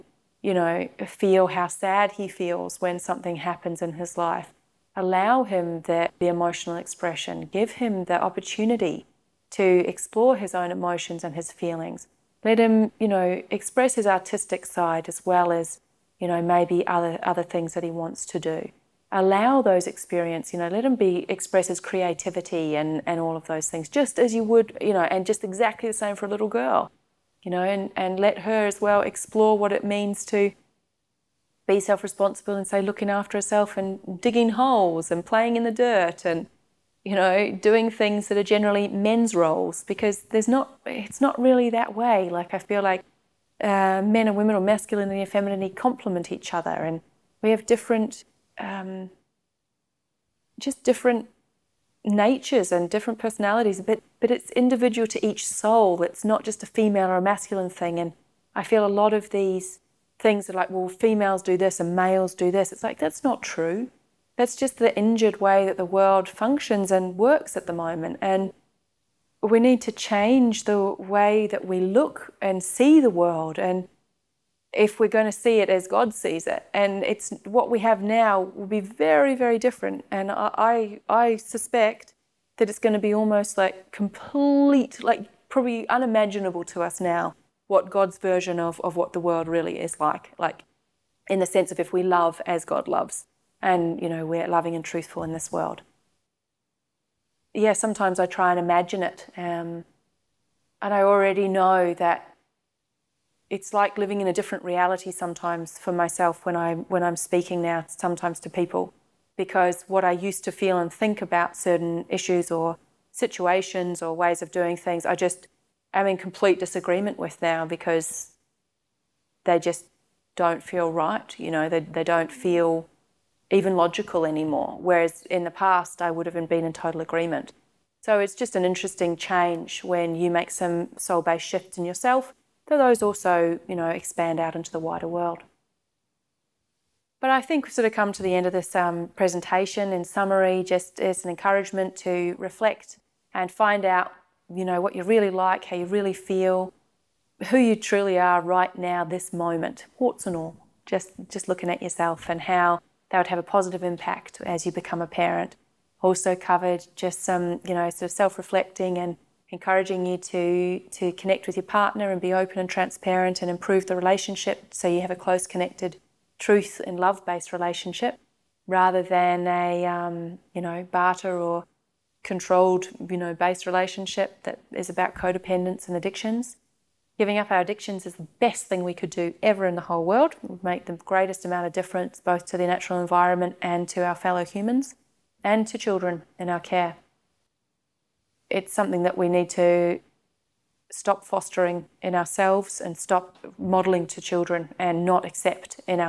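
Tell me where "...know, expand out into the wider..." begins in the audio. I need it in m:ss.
2:13.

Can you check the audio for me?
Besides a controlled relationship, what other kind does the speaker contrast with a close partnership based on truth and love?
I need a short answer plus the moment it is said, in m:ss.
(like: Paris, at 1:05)
barter, at 2:50.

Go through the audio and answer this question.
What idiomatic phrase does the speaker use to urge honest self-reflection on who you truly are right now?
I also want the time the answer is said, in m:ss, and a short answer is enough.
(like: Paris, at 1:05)
warts and all, at 2:29.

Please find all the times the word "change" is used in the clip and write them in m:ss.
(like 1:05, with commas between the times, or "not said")
1:09, 2:09.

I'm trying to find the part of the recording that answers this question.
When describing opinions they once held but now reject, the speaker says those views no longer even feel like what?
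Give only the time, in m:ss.
2:03.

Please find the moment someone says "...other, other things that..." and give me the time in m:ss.
0:16.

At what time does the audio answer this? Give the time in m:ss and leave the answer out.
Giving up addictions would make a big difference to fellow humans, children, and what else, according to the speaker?
3:02.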